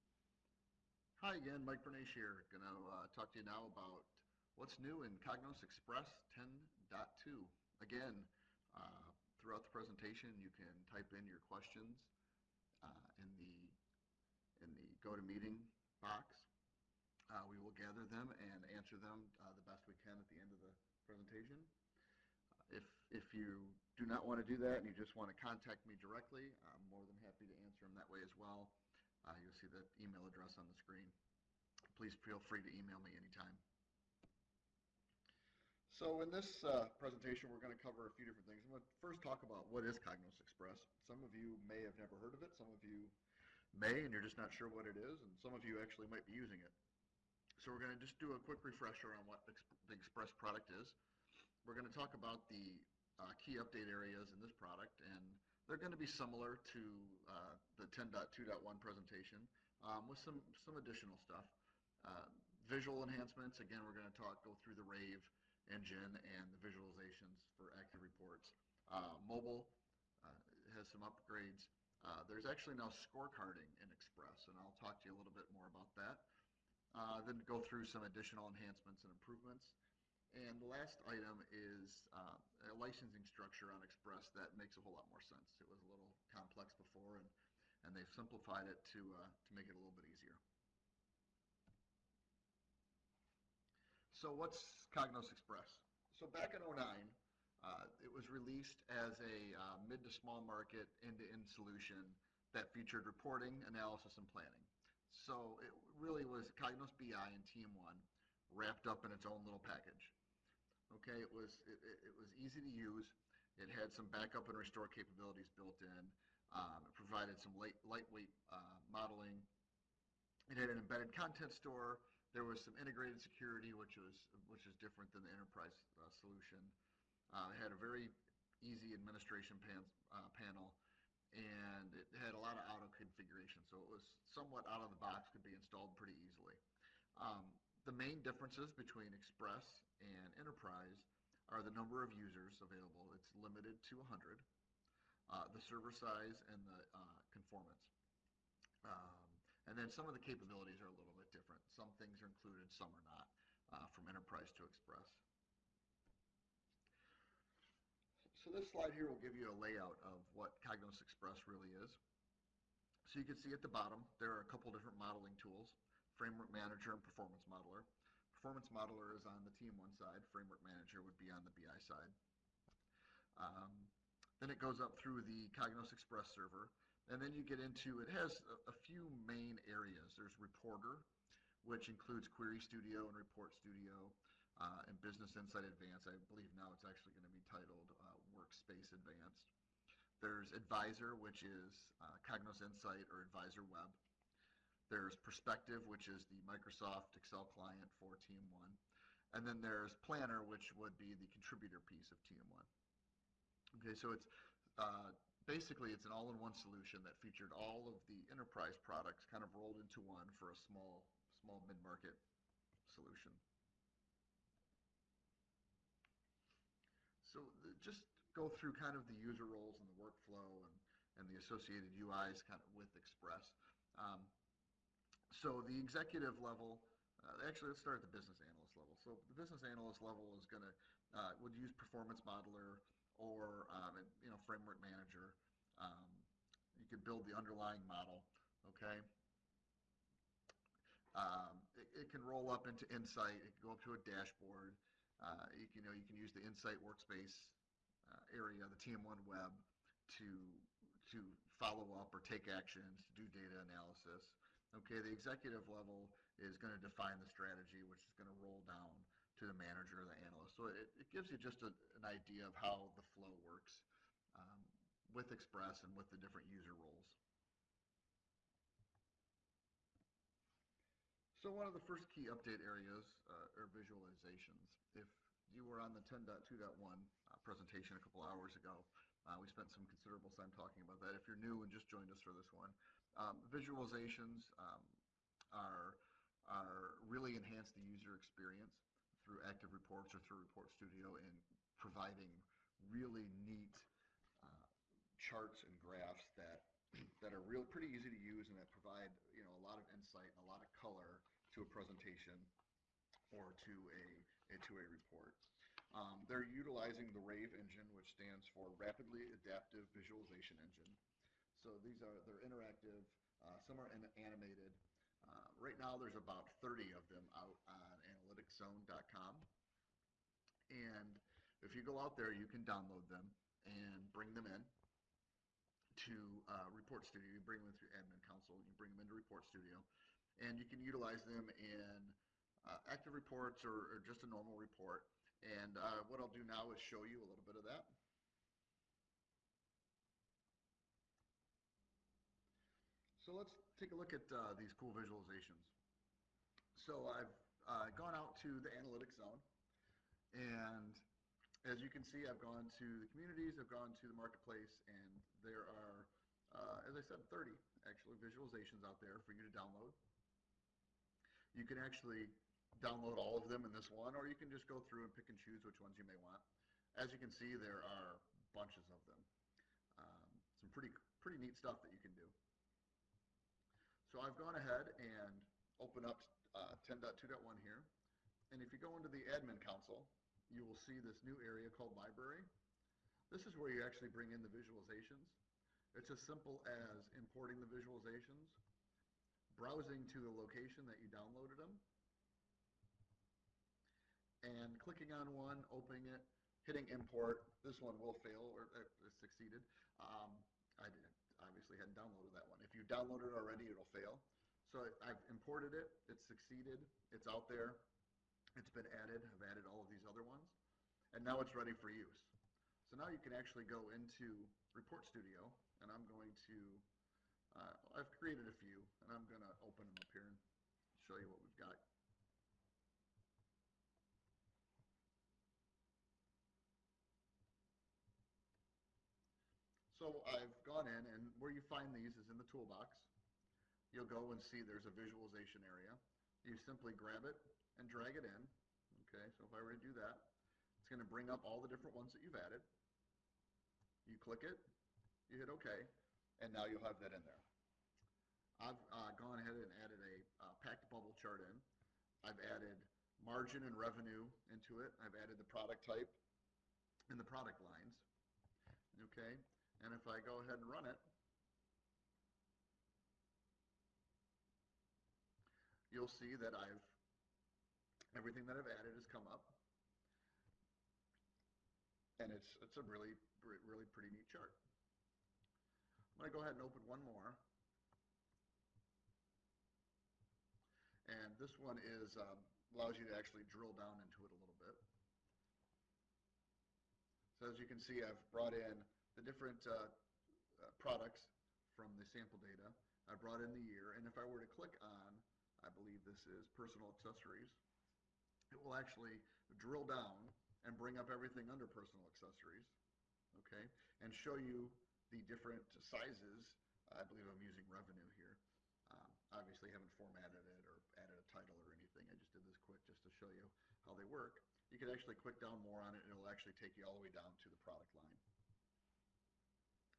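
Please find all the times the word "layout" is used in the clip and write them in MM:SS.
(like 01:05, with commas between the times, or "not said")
02:39.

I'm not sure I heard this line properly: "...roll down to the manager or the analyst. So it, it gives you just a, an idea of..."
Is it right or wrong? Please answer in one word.
right.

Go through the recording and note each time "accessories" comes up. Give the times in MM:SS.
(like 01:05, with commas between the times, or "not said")
08:16, 08:22.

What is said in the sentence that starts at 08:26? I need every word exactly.
I believe I'm using revenue here.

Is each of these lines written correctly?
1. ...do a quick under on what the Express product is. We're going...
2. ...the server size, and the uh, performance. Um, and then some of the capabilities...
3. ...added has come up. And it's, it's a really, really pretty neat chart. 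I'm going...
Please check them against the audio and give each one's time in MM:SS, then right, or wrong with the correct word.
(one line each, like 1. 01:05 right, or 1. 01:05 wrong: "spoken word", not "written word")
1. 00:48 wrong: "refresher", not "under"
2. 02:25 wrong: "conformance", not "performance"
3. 07:48 right.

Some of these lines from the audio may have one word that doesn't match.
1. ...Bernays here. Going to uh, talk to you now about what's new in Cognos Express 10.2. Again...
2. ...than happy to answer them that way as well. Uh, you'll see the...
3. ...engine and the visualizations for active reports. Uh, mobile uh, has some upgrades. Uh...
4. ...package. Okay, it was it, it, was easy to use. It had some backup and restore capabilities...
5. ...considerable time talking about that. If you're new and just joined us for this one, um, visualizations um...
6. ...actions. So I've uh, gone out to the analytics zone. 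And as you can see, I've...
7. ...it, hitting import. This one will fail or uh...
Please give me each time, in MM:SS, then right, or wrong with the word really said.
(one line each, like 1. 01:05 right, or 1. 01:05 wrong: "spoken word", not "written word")
1. 00:01 right
2. 00:27 right
3. 01:05 right
4. 01:49 right
5. 04:39 right
6. 05:44 wrong: "visualizations", not "actions"
7. 06:36 right.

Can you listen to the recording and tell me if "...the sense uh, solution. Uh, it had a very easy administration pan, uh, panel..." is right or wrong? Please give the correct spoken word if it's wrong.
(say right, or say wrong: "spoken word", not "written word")
wrong: "enterprise", not "sense".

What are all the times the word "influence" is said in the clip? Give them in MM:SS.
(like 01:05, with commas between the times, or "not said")
not said.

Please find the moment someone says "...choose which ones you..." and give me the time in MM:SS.
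06:05.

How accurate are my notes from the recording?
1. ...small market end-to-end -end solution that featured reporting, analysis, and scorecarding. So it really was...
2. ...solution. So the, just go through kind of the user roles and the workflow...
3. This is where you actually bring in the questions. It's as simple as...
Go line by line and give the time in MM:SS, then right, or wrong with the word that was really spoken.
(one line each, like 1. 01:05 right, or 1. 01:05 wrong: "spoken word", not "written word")
1. 01:40 wrong: "planning", not "scorecarding"
2. 03:32 right
3. 06:23 wrong: "visualizations", not "questions".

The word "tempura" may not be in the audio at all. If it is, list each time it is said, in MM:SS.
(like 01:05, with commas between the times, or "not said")
not said.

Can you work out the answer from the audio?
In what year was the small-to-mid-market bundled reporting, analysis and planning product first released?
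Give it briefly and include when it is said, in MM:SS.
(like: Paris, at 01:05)
2009, at 01:36.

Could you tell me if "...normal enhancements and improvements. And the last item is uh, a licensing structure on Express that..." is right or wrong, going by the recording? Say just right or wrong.
wrong.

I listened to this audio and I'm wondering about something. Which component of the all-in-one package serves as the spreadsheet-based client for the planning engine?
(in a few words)
Perspective.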